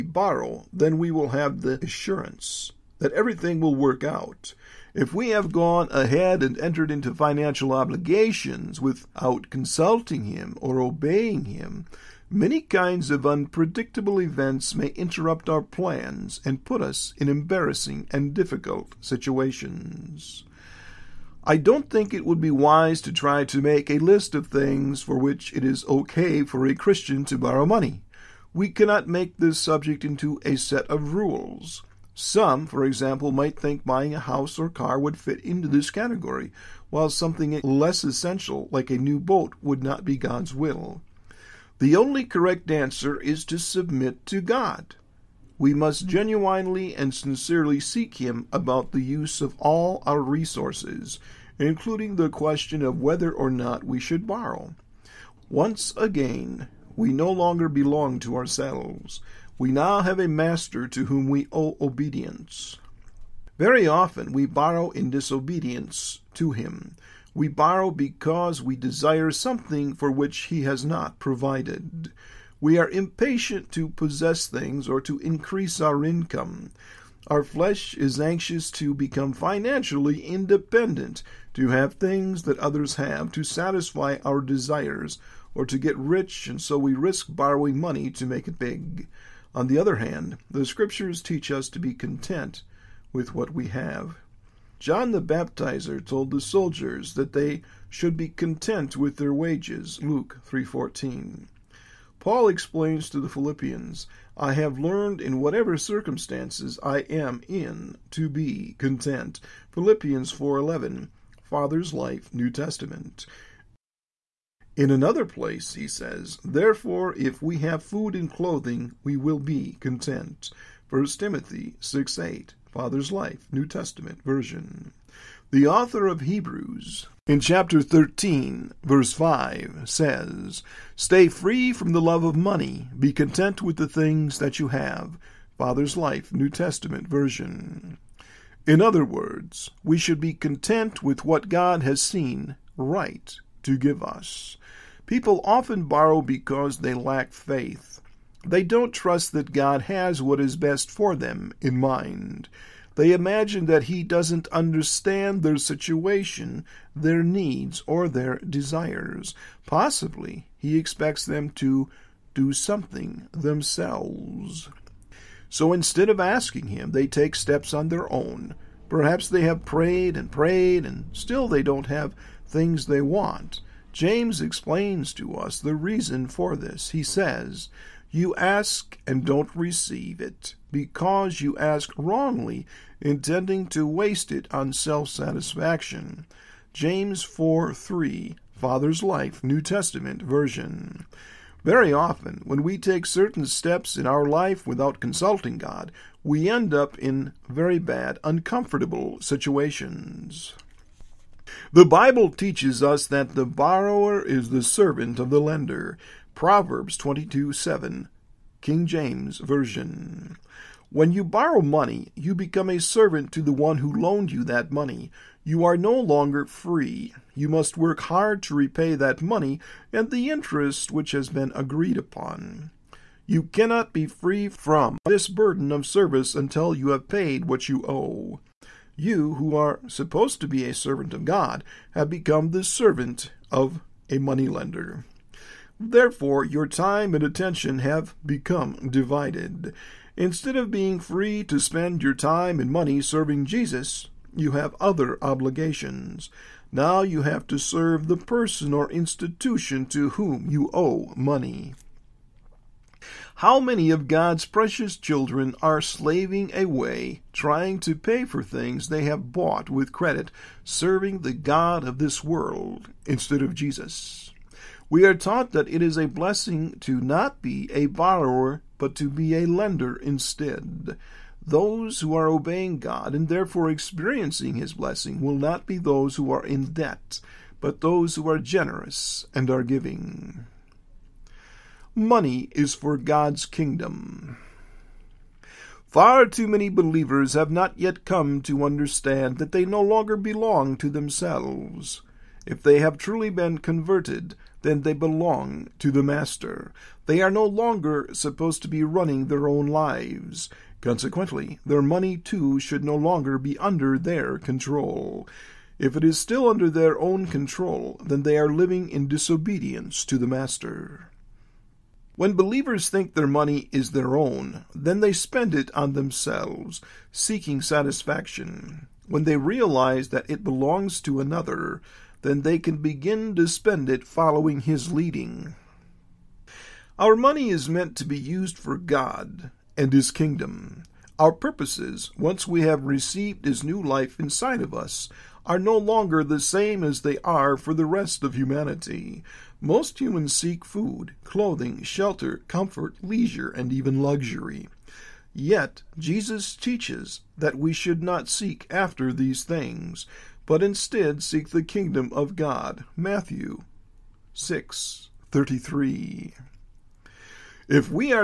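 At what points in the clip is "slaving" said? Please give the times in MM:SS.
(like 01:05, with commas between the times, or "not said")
04:15.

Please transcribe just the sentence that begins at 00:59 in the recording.
We now have a master to whom we owe obedience.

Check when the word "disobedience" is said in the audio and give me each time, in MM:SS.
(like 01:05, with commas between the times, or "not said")
01:05, 05:09.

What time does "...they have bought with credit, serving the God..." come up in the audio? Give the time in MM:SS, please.
04:18.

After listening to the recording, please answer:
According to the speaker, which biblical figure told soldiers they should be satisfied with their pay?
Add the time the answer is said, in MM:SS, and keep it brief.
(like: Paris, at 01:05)
John the Baptizer, at 01:34.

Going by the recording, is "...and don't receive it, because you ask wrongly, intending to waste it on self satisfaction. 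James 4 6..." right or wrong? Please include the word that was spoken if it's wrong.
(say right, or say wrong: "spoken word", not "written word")
wrong: "3", not "6".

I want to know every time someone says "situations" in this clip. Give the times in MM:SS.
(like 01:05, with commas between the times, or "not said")
00:19, 02:35, 03:19.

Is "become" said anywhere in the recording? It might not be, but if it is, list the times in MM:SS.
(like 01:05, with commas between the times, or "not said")
01:18, 03:32, 03:52, 03:58.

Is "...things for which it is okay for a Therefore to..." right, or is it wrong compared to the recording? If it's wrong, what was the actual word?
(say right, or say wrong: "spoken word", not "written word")
wrong: "Christian", not "Therefore".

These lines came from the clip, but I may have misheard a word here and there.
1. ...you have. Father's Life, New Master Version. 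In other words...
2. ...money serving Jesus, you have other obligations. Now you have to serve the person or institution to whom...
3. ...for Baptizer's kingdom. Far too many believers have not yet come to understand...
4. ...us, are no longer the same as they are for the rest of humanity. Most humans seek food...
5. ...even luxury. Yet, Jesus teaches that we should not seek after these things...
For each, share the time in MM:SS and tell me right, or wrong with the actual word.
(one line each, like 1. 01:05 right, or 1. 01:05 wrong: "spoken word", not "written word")
1. 02:14 wrong: "Testament", not "Master"
2. 04:02 right
3. 04:42 wrong: "God", not "Baptizer"
4. 05:34 right
5. 05:43 right.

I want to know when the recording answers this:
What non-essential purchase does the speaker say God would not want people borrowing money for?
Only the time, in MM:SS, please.
00:38.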